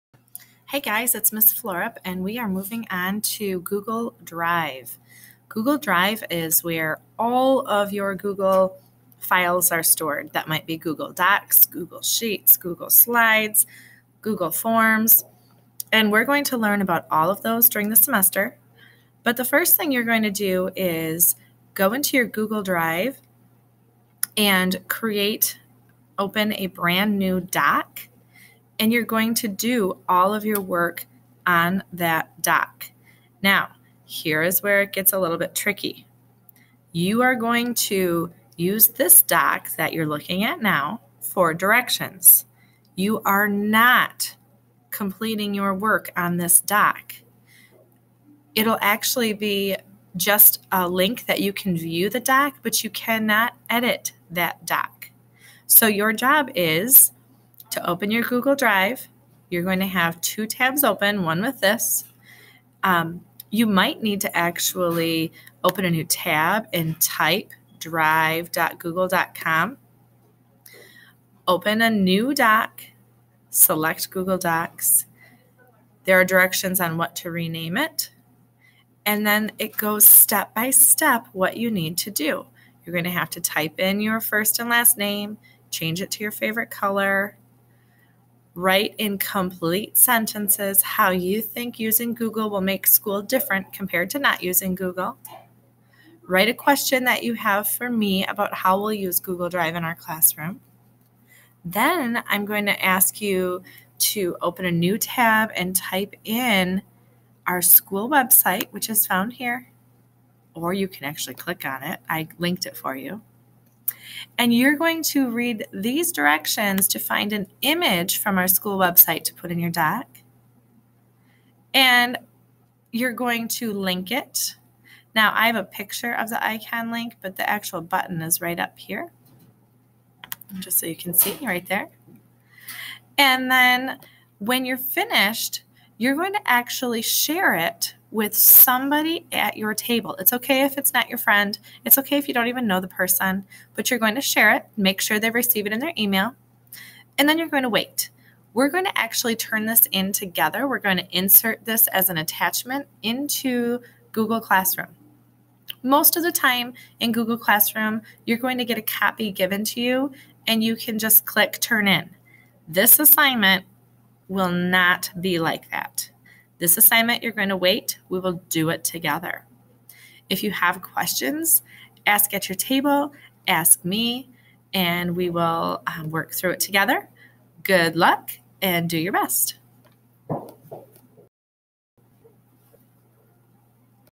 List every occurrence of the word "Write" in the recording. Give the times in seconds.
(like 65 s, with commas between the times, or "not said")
88 s, 96 s.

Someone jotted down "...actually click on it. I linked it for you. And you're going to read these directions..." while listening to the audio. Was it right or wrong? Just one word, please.
right.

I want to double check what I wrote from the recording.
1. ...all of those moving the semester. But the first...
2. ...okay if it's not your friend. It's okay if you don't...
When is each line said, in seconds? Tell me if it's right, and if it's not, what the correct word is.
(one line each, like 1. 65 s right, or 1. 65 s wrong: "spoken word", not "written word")
1. 17 s wrong: "during", not "moving"
2. 140 s right.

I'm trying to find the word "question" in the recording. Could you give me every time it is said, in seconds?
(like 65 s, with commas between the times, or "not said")
96 s, 170 s.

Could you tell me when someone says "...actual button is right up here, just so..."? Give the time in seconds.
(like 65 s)
127 s.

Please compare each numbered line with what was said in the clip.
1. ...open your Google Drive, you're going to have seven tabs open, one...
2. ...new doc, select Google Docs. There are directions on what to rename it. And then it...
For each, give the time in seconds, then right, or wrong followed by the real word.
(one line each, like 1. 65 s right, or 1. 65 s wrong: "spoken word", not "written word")
1. 57 s wrong: "two", not "seven"
2. 71 s right.